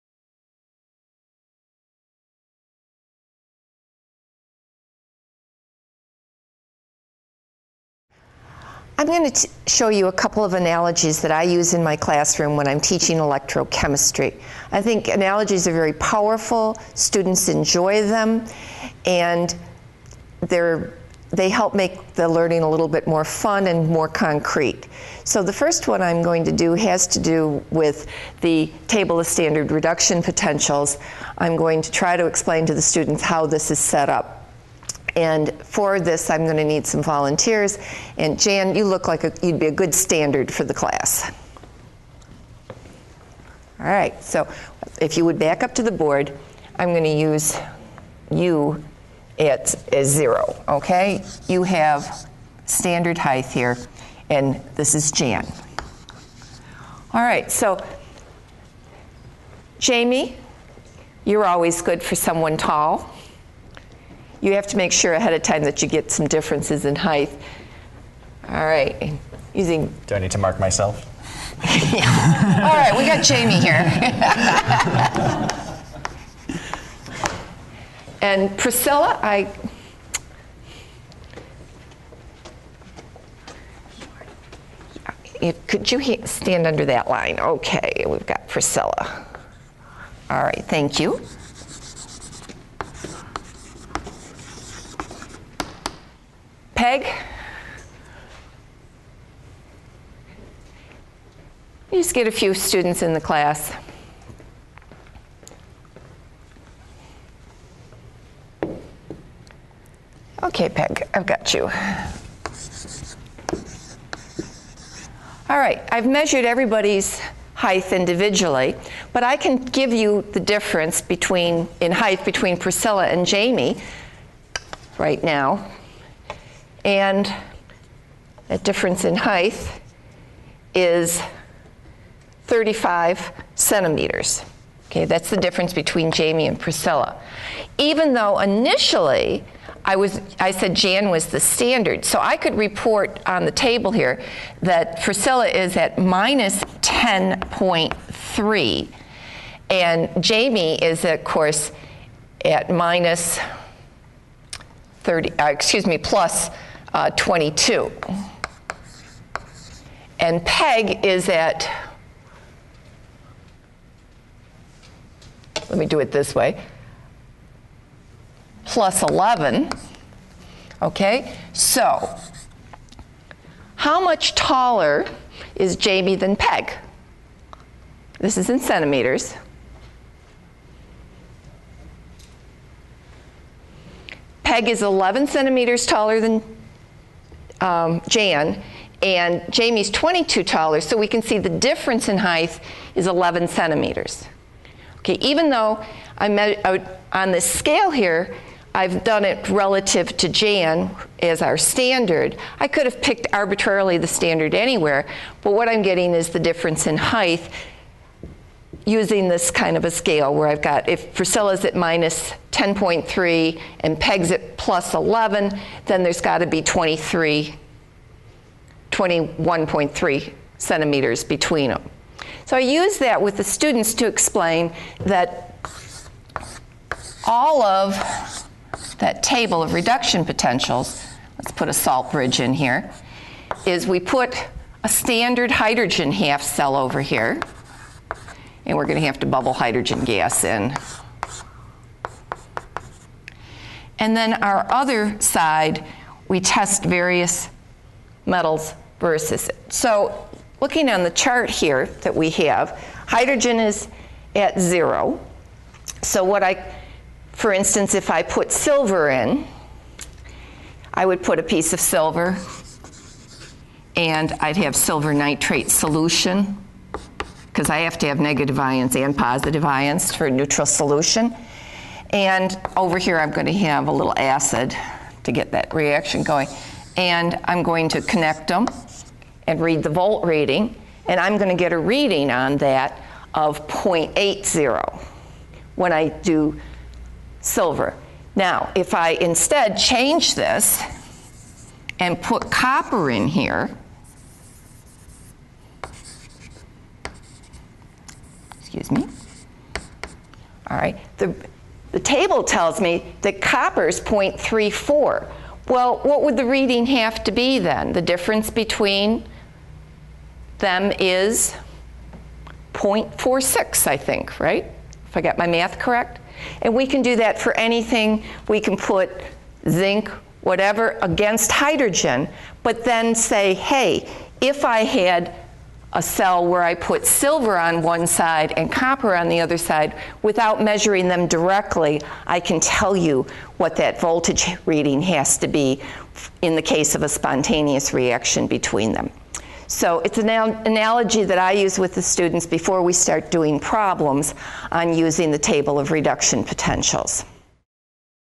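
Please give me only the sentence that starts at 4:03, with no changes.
And then our other side, we test various metals versus it.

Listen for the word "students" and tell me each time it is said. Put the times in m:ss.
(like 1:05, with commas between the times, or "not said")
0:16, 0:32, 1:42, 3:43, 5:42.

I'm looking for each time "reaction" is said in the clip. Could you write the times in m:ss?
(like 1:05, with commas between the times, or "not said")
4:35, 5:37.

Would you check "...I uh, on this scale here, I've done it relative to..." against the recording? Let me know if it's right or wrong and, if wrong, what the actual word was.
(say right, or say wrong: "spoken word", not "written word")
right.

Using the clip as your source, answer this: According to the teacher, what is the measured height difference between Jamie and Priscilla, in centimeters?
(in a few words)
35 centimeters.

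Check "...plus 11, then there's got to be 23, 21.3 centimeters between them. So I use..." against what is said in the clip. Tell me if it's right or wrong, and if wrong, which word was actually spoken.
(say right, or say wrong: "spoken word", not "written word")
right.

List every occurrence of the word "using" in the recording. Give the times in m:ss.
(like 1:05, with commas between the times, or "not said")
1:09, 3:28, 5:44.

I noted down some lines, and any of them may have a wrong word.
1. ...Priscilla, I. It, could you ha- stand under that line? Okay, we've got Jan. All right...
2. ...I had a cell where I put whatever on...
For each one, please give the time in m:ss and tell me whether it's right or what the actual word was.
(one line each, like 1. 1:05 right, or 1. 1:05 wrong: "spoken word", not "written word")
1. 1:18 wrong: "Priscilla", not "Jan"
2. 5:24 wrong: "silver", not "whatever".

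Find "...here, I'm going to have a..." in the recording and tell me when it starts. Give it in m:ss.
4:32.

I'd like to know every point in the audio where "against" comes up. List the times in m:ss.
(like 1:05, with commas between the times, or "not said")
5:21.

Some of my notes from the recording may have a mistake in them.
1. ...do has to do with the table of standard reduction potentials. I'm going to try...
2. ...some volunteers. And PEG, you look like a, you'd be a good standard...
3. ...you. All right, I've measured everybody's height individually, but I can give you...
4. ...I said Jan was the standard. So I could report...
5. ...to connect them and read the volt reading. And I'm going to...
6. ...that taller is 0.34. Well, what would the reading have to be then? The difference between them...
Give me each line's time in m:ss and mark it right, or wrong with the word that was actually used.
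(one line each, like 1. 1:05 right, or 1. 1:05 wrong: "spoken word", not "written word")
1. 0:26 right
2. 0:36 wrong: "Jan", not "PEG"
3. 1:51 right
4. 2:20 right
5. 4:37 right
6. 5:03 wrong: "copper", not "taller".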